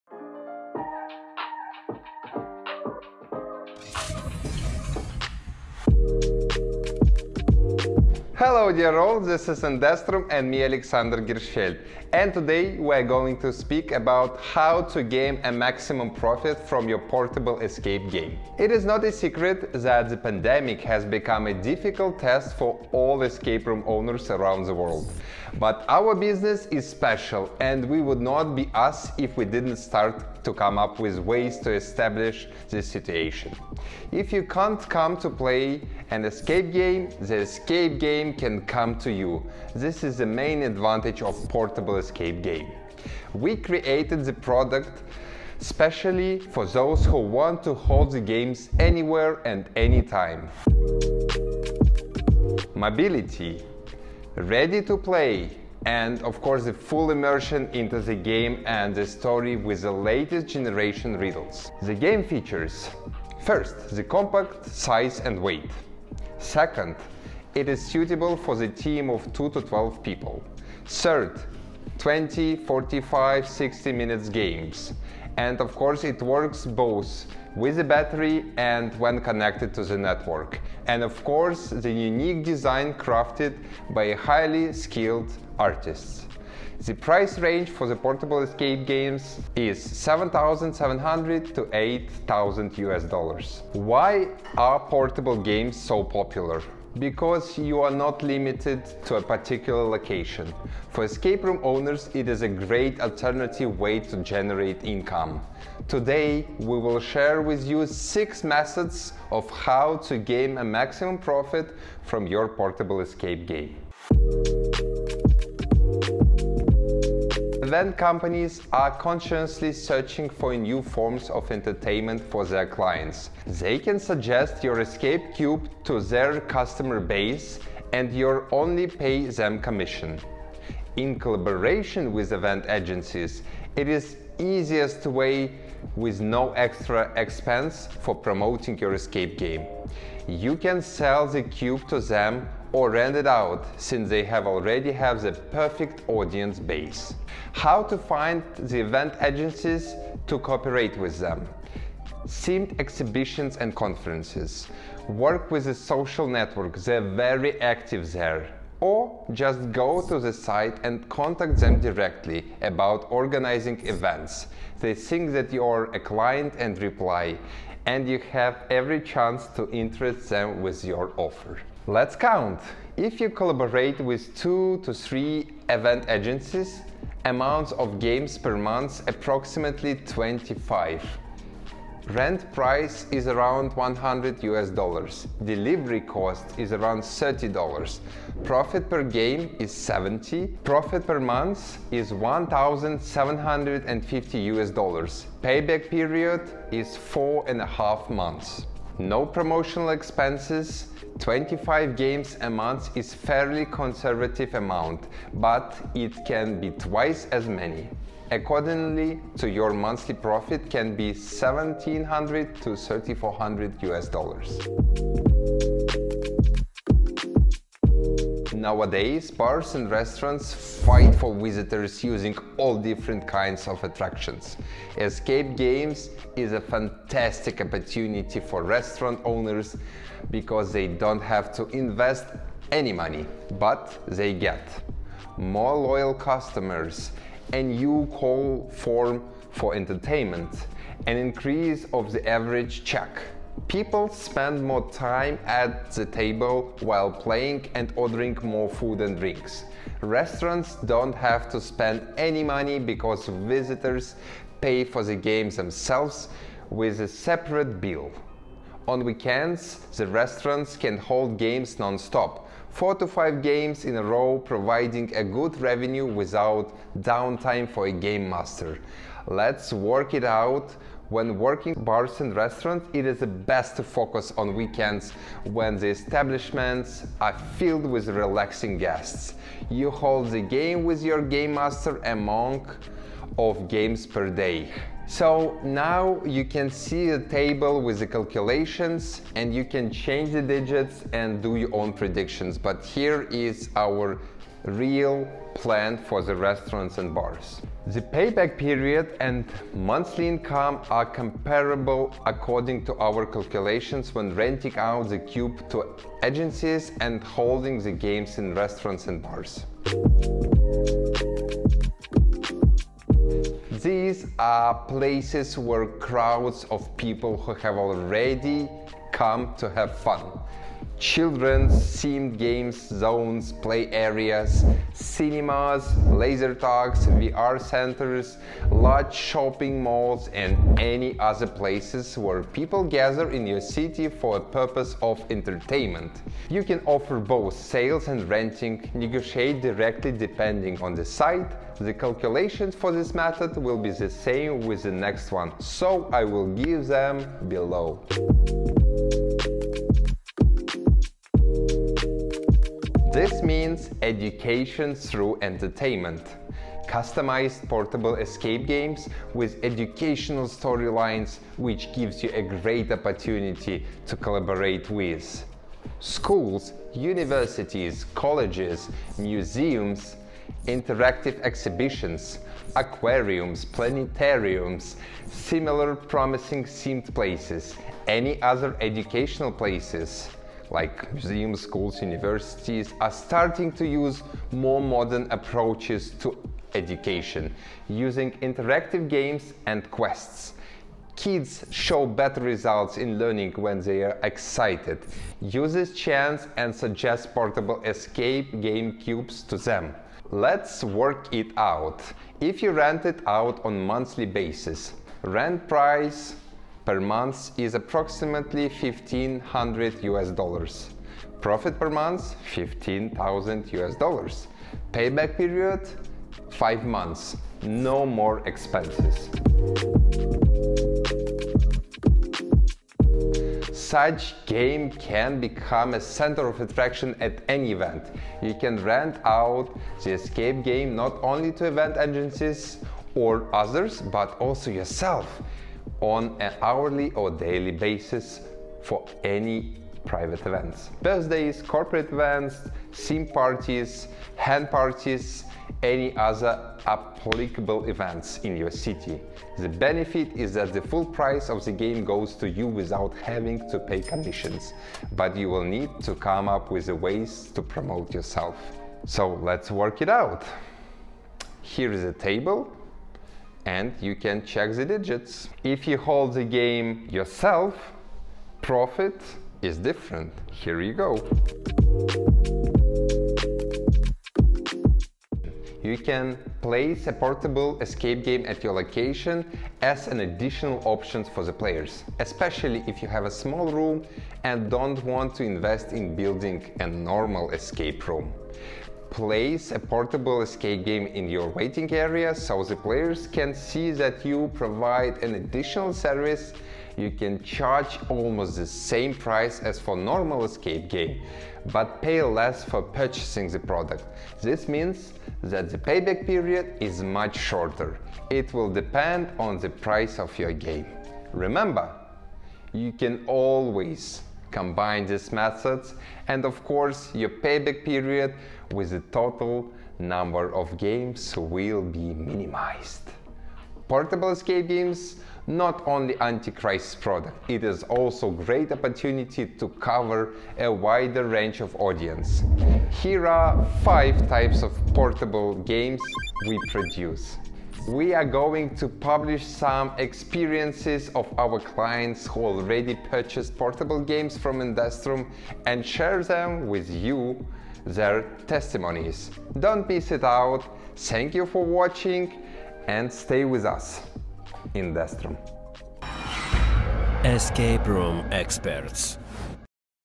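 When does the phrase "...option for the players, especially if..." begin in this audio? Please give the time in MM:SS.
08:00.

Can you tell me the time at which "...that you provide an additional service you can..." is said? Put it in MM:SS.
08:13.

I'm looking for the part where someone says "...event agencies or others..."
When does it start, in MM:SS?
07:11.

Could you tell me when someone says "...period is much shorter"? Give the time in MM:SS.
08:26.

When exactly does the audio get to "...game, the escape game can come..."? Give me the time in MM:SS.
00:36.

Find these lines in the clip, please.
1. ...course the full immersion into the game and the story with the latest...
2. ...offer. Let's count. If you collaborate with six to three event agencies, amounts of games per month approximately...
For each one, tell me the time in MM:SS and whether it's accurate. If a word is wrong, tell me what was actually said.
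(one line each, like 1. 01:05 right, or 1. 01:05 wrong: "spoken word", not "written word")
1. 00:56 right
2. 02:51 wrong: "two", not "six".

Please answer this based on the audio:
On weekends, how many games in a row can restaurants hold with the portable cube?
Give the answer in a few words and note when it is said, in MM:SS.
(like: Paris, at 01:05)
4 to 5, at 04:22.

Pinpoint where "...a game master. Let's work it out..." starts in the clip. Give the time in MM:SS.
04:27.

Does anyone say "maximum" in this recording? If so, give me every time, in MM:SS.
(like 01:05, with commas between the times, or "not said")
00:15, 01:50.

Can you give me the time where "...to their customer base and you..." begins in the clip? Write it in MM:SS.
02:05.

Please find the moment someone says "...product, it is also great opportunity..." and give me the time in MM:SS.
08:47.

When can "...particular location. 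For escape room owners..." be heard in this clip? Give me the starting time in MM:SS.
01:39.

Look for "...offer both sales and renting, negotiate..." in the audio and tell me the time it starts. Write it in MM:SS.
05:36.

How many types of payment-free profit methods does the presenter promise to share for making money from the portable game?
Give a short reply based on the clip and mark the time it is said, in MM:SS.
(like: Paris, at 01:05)
6, at 01:47.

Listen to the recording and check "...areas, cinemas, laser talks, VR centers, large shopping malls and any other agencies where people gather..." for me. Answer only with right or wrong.
wrong.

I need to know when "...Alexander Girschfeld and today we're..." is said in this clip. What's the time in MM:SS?
00:10.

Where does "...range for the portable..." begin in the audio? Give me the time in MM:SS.
01:27.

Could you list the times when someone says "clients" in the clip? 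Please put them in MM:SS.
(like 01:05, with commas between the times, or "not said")
02:02, 02:45, 09:01.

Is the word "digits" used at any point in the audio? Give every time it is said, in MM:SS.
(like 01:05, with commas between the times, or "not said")
04:50, 07:44.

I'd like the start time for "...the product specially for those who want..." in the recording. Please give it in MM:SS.
00:44.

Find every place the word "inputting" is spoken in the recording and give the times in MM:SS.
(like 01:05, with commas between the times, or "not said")
not said.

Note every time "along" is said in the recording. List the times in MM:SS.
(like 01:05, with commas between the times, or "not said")
not said.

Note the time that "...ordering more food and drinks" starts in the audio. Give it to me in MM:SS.
04:07.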